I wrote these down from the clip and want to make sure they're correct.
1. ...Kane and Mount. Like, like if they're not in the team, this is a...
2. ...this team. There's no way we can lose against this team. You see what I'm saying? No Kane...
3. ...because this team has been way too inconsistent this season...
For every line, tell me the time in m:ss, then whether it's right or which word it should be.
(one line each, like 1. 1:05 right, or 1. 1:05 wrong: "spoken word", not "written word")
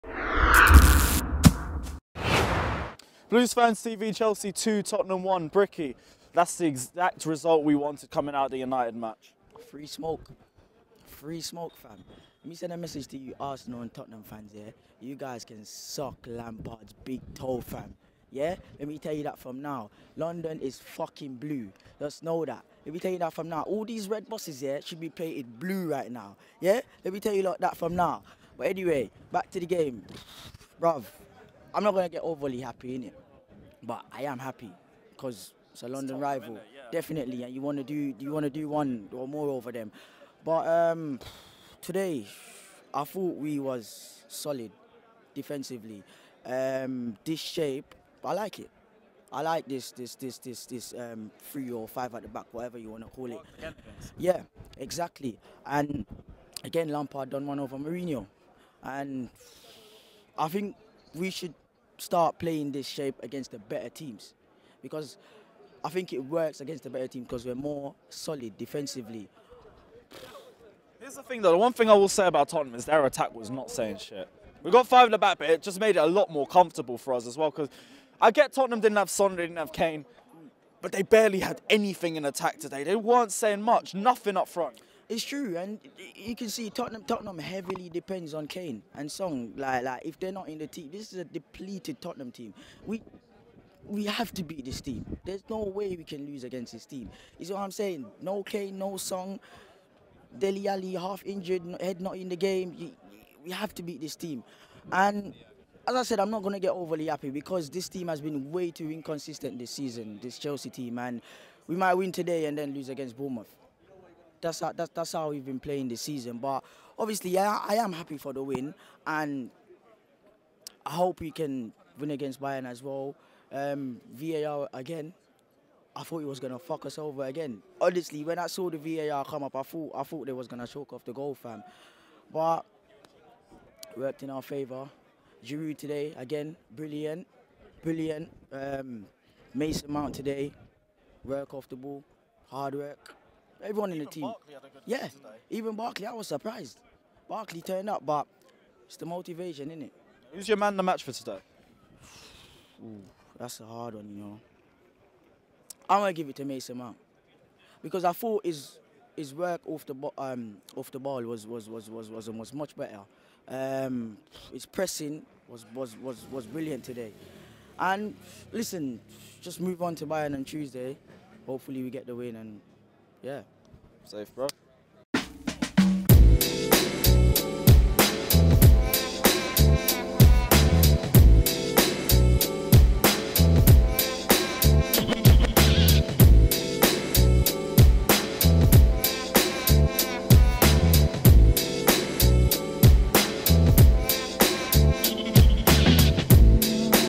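1. 1:28 wrong: "Son", not "Mount"
2. 1:34 right
3. 1:47 right.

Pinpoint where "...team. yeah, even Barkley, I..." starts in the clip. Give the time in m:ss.
2:24.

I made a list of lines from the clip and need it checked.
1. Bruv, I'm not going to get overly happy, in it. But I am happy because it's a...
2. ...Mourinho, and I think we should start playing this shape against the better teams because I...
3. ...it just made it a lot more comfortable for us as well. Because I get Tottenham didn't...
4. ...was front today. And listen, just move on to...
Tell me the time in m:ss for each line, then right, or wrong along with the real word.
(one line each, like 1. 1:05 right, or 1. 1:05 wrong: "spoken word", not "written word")
1. 0:30 right
2. 0:57 right
3. 1:15 right
4. 2:46 wrong: "brilliant", not "front".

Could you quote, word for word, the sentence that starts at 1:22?
They weren't saying much, nothing up front.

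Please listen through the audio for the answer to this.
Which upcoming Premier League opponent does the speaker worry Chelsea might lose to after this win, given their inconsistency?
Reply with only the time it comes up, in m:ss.
1:53.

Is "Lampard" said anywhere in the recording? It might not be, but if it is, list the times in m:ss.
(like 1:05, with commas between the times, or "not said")
0:16, 0:56.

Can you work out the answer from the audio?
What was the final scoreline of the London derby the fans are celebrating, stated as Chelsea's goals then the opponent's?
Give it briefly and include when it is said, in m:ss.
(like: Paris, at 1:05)
2-1, at 0:04.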